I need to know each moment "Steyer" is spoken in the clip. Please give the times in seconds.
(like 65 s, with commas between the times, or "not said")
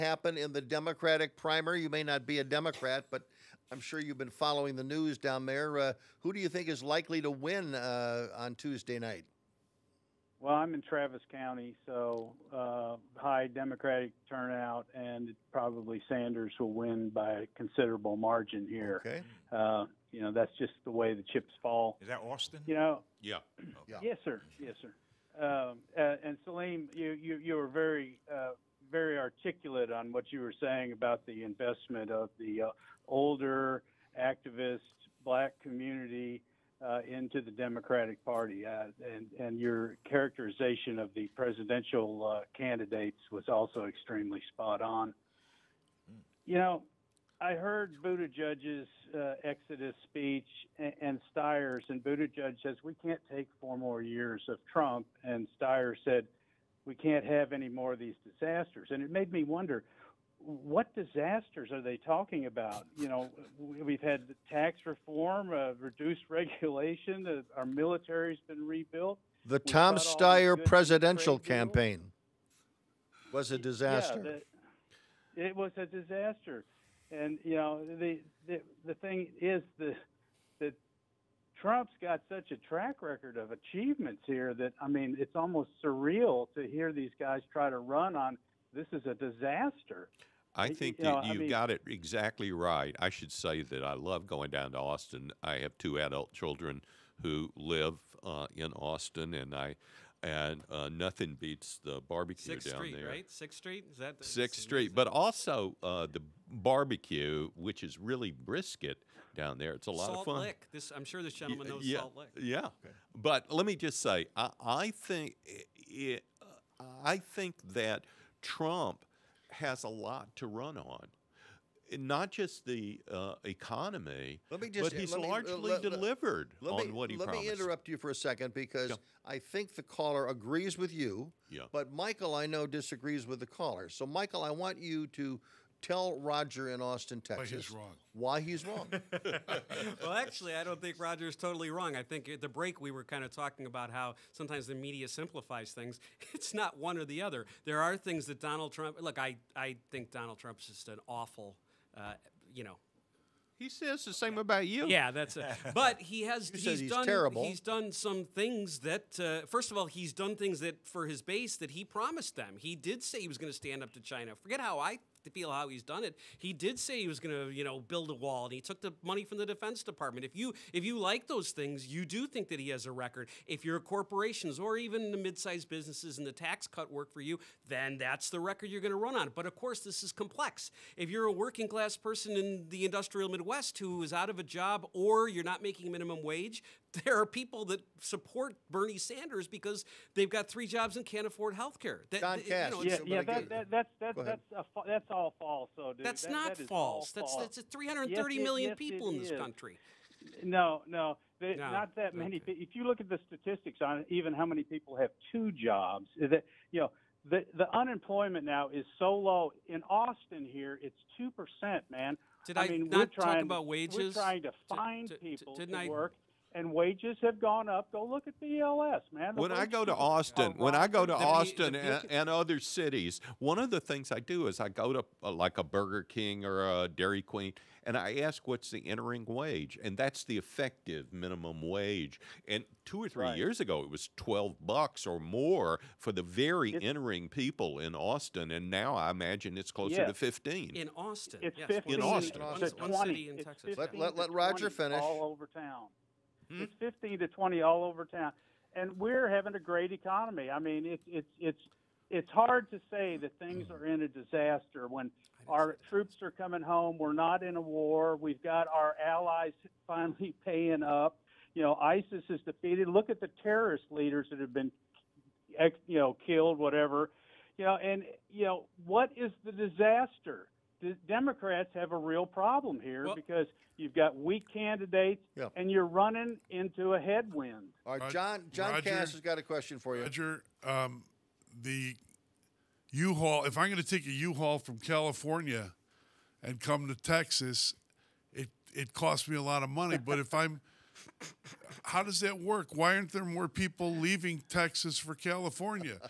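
51 s, 55 s, 69 s.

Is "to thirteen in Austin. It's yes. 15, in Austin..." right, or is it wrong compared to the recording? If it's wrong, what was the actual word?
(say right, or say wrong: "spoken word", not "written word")
wrong: "fifteen", not "thirteen".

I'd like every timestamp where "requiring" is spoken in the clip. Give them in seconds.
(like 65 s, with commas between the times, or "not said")
not said.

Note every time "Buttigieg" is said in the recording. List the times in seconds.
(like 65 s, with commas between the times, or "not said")
48 s, 52 s.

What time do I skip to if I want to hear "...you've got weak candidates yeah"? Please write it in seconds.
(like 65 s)
273 s.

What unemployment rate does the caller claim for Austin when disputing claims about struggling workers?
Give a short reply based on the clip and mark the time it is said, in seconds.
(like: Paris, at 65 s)
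2 percent, at 211 s.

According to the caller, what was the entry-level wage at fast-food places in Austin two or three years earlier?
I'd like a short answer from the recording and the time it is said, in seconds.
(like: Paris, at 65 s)
$12, at 234 s.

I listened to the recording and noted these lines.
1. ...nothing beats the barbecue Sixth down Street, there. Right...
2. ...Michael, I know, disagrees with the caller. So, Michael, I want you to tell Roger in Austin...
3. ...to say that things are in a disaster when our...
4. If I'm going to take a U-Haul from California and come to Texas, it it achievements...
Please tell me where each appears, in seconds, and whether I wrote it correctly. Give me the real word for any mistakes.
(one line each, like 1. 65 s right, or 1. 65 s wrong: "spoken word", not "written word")
1. 100 s right
2. 131 s right
3. 252 s right
4. 283 s wrong: "costs", not "achievements".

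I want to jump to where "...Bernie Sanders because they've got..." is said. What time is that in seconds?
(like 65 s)
188 s.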